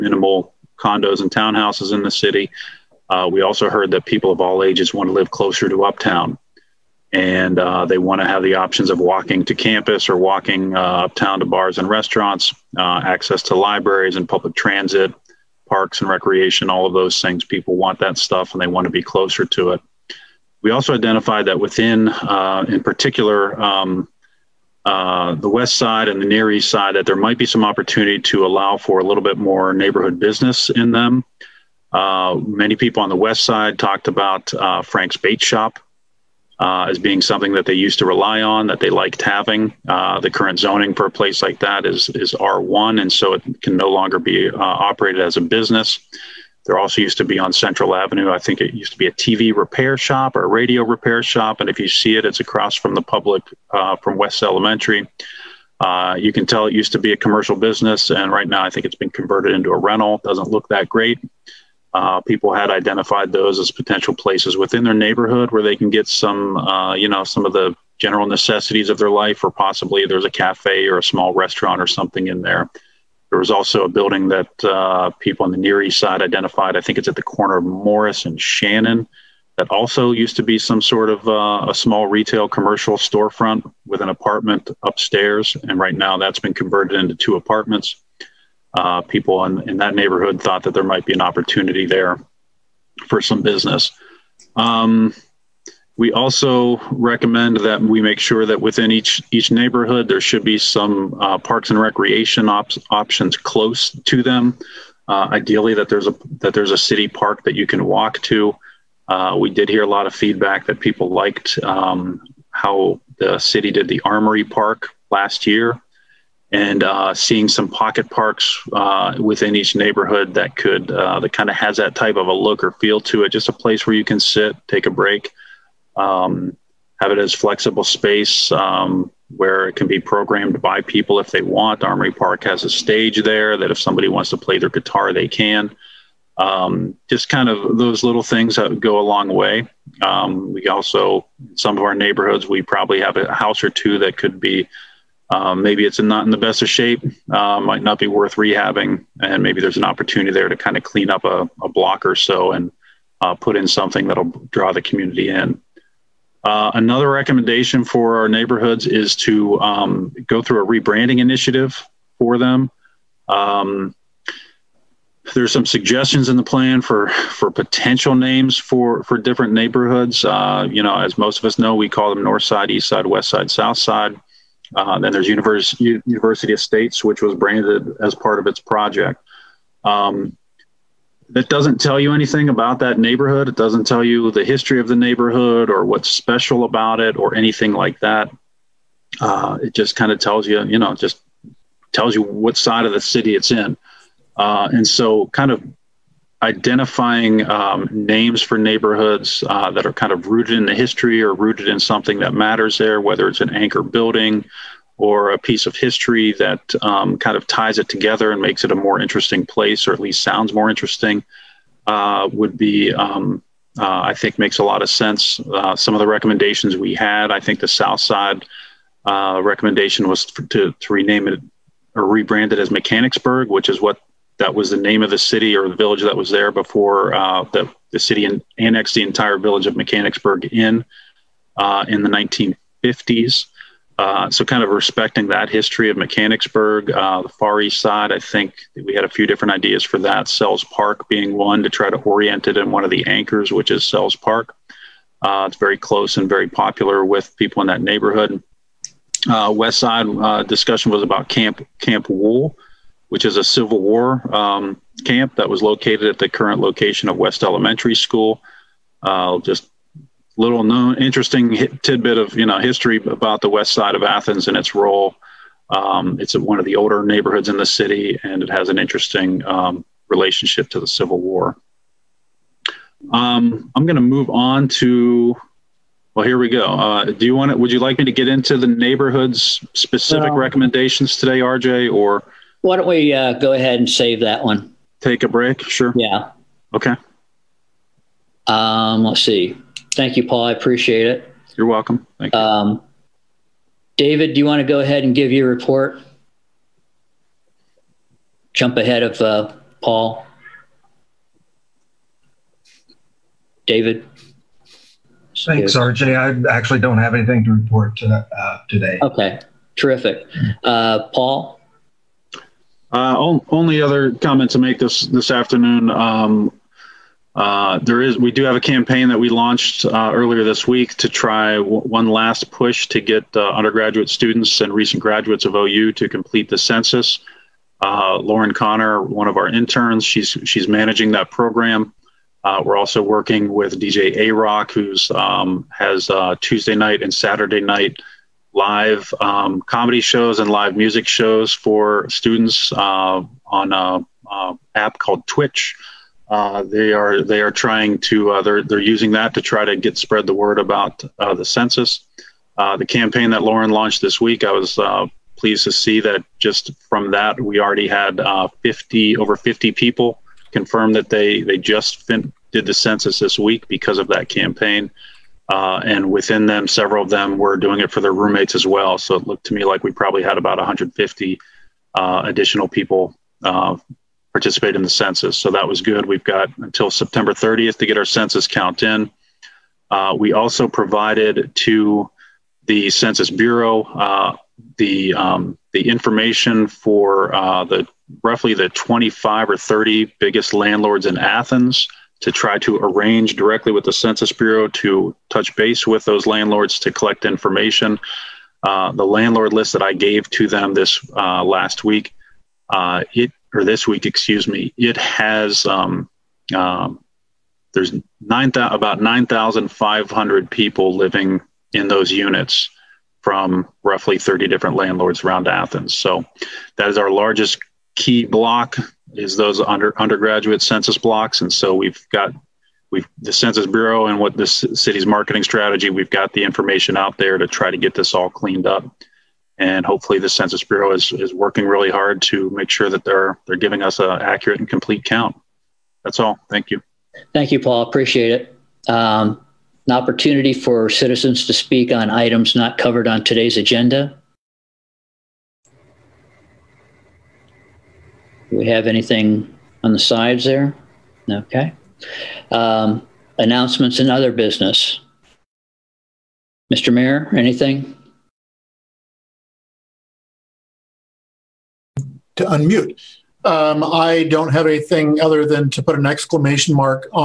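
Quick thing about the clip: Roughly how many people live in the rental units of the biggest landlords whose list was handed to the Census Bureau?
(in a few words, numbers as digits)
9,500.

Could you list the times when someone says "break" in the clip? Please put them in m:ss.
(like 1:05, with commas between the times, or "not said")
2:04, 4:45.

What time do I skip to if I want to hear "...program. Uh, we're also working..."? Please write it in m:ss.
5:31.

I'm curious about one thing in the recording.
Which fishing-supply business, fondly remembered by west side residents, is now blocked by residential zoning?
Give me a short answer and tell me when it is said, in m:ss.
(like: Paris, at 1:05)
Frank's Bait Shop, at 0:34.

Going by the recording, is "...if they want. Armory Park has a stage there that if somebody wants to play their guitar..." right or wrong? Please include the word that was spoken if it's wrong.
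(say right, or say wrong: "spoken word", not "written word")
right.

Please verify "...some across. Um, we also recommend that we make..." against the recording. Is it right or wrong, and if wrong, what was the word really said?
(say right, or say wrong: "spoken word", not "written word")
wrong: "business", not "across".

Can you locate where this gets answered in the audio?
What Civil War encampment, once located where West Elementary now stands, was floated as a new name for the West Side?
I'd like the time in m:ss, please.
4:11.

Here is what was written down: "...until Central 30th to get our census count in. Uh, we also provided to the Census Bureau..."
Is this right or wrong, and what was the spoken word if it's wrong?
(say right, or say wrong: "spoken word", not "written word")
wrong: "September", not "Central".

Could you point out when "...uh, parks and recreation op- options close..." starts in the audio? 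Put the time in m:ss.
1:41.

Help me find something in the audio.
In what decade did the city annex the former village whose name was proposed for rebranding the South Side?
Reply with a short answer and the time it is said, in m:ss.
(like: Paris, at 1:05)
1950s, at 3:52.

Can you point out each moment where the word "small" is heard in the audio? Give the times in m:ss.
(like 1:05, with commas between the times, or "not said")
1:11, 1:21.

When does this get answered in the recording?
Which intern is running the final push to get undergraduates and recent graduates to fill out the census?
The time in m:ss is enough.
5:28.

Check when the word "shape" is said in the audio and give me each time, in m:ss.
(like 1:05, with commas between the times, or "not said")
2:26.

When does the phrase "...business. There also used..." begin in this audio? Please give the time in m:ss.
0:45.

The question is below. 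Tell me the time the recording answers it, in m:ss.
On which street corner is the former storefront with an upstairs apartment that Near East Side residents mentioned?
1:17.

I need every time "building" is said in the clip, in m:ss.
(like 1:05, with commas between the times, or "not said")
1:13, 3:23.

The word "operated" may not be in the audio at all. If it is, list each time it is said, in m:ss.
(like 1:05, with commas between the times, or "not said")
0:44.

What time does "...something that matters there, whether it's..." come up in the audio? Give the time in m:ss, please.
3:21.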